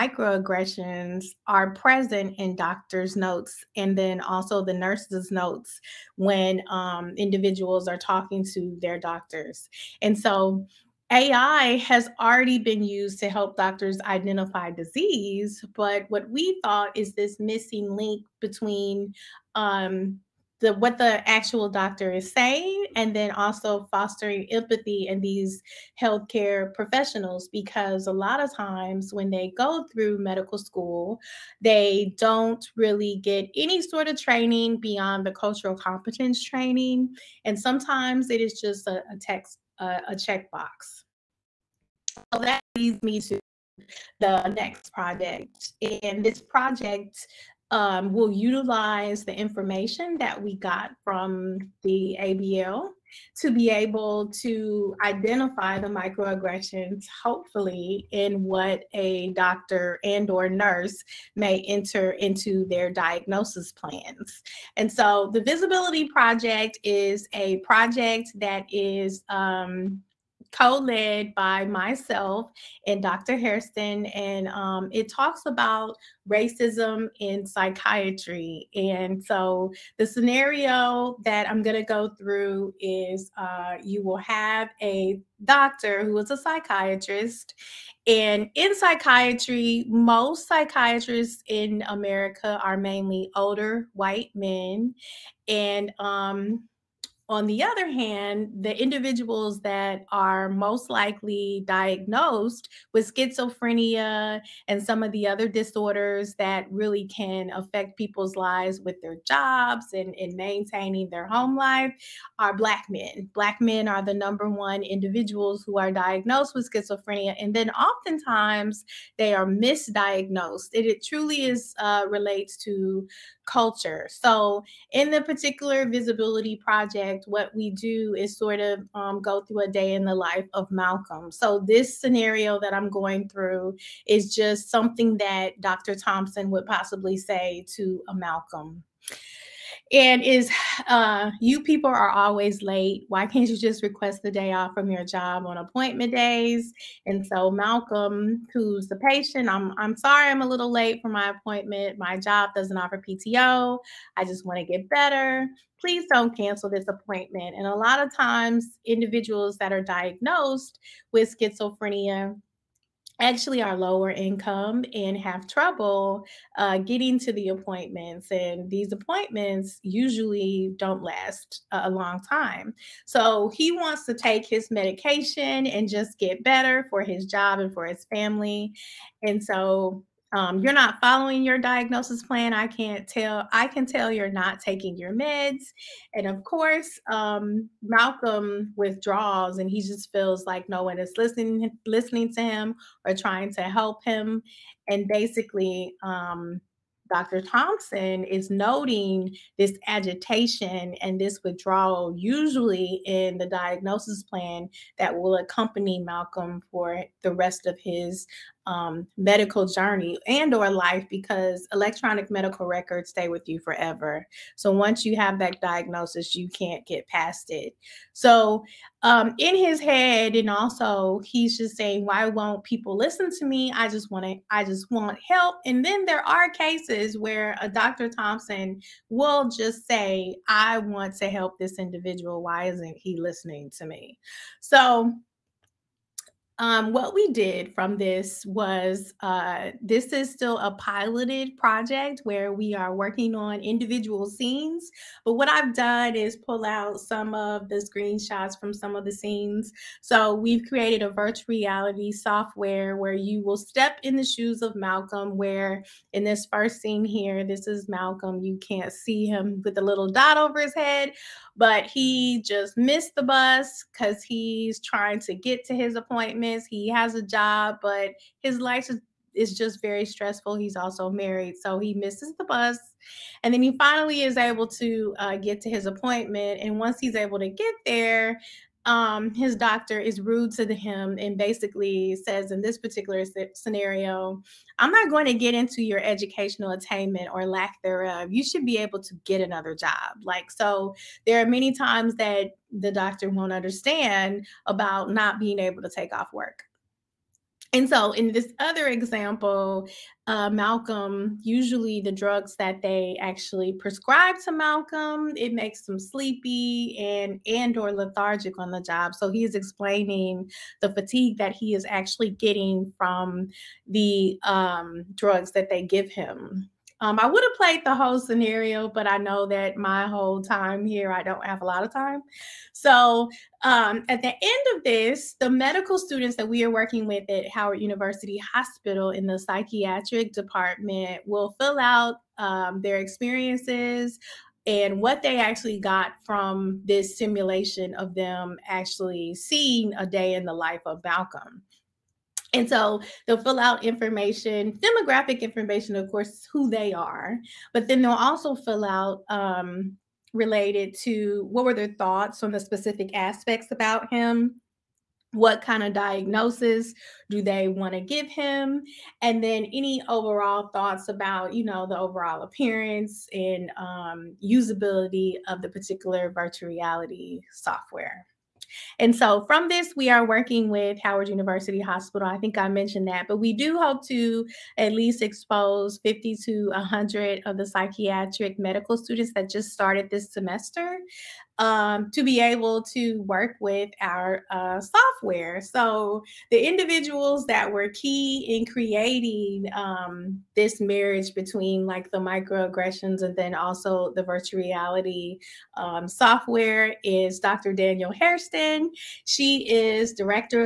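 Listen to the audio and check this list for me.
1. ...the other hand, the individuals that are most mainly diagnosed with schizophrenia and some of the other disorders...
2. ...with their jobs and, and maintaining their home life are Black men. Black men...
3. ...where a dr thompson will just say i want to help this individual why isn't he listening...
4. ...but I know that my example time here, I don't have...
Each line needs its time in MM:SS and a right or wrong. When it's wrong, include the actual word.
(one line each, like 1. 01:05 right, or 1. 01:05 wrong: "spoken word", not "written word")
1. 01:37 wrong: "likely", not "mainly"
2. 01:48 right
3. 03:47 right
4. 05:18 wrong: "whole", not "example".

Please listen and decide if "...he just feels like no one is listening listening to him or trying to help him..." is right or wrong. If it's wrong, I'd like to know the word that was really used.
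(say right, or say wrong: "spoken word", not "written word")
right.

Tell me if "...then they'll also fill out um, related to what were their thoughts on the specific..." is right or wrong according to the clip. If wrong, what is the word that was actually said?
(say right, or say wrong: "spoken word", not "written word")
right.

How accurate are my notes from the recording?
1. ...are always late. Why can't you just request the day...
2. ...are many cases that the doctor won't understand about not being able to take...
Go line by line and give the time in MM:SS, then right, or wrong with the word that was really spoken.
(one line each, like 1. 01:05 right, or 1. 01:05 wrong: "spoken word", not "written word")
1. 02:21 right
2. 04:51 wrong: "times", not "cases".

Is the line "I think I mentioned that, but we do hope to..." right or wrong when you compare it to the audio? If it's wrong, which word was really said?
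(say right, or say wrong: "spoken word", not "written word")
right.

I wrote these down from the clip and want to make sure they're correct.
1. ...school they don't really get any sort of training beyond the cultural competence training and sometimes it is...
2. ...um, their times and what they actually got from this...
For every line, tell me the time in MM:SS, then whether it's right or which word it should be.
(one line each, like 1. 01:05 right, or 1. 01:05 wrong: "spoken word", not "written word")
1. 00:30 right
2. 05:32 wrong: "experiences", not "times".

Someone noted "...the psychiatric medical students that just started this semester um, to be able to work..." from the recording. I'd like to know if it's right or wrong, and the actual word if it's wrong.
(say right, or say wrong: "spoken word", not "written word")
right.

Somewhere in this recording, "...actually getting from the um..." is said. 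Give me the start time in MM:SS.
05:11.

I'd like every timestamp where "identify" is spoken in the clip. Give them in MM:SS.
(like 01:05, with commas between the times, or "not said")
00:14, 00:55.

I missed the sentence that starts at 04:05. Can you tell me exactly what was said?
But what I've done is pull out some of the screenshots from some of the scenes.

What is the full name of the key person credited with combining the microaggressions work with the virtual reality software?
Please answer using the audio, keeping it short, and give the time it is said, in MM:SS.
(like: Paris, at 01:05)
Danielle Hairston, at 06:37.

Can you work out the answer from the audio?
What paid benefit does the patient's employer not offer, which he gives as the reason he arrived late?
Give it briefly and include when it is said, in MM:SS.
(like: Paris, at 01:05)
PTO, at 02:33.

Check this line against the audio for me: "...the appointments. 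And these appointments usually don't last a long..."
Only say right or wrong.
right.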